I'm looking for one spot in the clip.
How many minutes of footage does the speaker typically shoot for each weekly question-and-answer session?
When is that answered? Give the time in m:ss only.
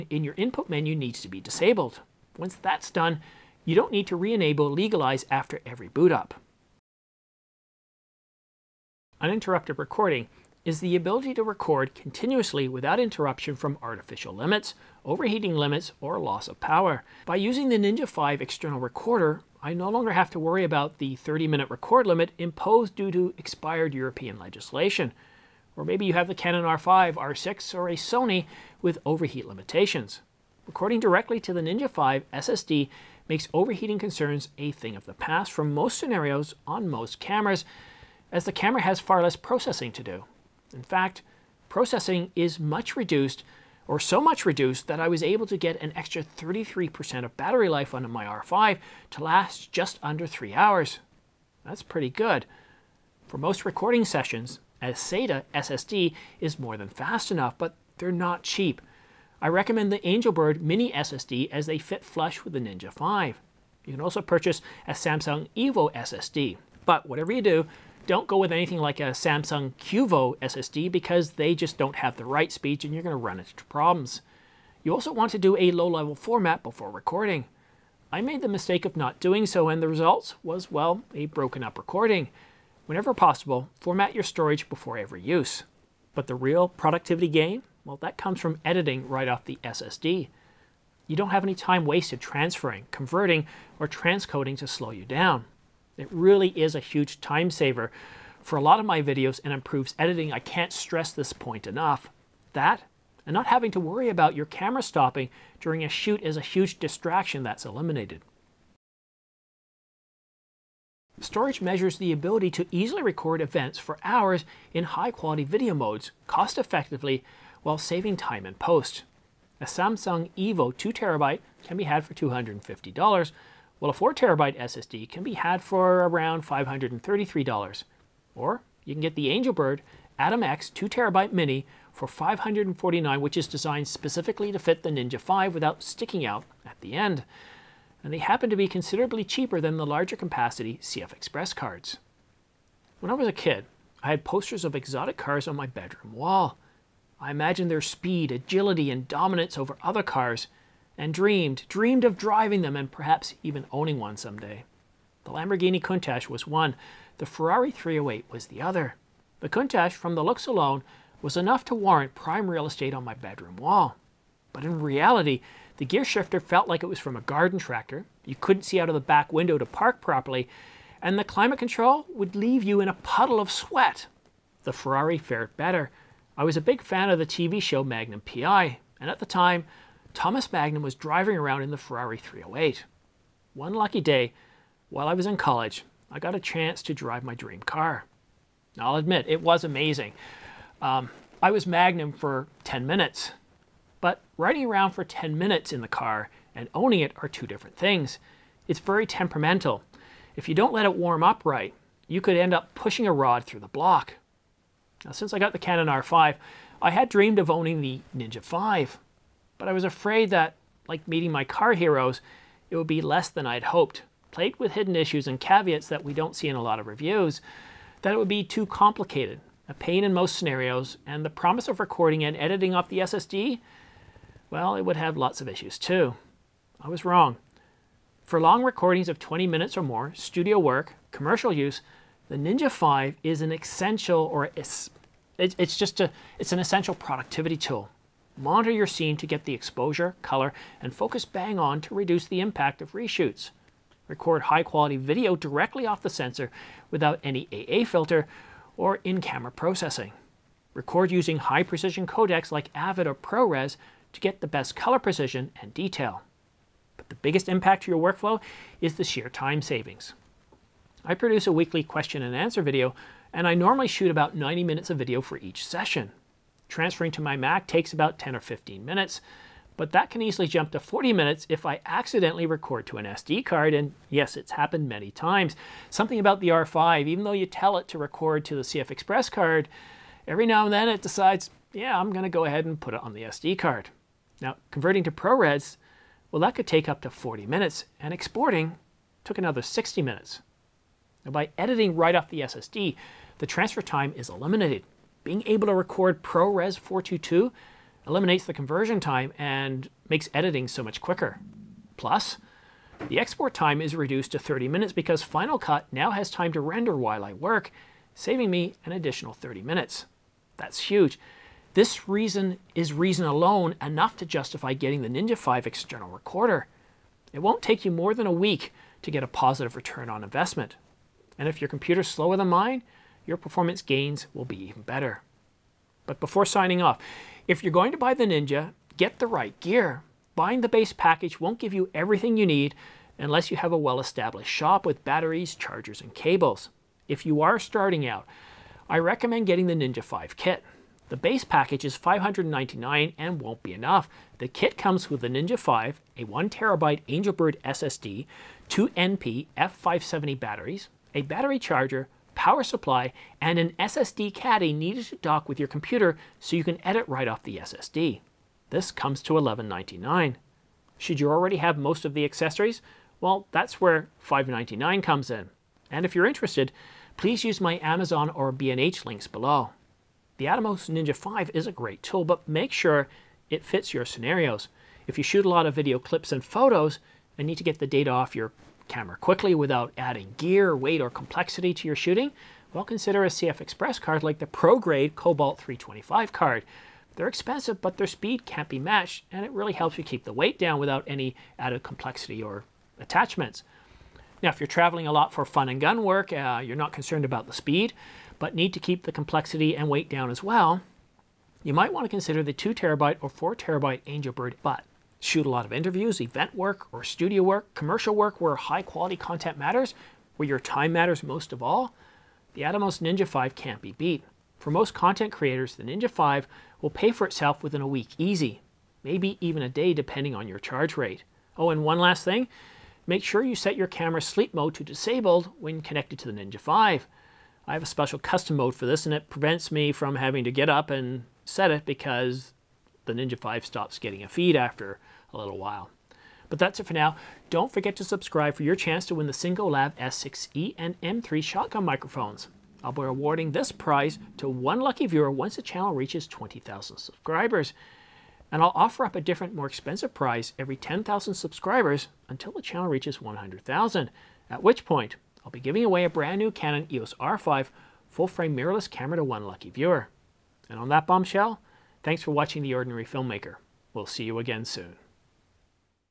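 4:24.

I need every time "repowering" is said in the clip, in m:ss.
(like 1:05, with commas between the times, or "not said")
not said.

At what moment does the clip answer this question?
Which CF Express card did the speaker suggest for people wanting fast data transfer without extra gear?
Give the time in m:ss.
6:24.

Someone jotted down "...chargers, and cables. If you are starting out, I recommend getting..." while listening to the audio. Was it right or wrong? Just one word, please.
right.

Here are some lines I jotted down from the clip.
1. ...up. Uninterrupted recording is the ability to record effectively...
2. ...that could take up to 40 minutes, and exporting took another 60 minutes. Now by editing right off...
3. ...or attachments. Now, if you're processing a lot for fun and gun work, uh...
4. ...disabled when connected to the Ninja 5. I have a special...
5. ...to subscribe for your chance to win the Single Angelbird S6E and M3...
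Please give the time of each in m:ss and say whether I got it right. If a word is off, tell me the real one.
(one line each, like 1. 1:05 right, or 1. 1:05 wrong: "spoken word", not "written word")
1. 0:06 wrong: "continuously", not "effectively"
2. 4:46 right
3. 6:32 wrong: "traveling", not "processing"
4. 7:04 right
5. 7:17 wrong: "Lab", not "Angelbird".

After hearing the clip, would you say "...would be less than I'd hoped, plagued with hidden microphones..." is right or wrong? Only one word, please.
wrong.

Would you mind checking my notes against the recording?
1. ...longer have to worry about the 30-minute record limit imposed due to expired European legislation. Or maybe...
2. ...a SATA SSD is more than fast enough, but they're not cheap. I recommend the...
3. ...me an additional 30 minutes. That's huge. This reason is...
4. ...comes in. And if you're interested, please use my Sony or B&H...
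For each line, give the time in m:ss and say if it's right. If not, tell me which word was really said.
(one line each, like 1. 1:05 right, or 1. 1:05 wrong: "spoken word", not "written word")
1. 0:19 right
2. 0:54 right
3. 5:08 right
4. 6:05 wrong: "Amazon", not "Sony".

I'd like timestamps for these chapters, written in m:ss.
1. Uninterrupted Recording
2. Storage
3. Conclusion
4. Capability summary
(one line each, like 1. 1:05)
1. 0:06
2. 1:24
3. 2:22
4. 6:10.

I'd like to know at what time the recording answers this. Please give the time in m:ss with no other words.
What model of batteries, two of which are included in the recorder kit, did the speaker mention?
5:48.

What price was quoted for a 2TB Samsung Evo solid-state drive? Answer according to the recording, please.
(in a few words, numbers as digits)
$250.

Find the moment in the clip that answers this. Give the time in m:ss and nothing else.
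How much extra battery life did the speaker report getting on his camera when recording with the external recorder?
0:46.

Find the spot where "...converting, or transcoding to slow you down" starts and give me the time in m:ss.
1:32.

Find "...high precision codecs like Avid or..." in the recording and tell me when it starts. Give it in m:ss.
4:11.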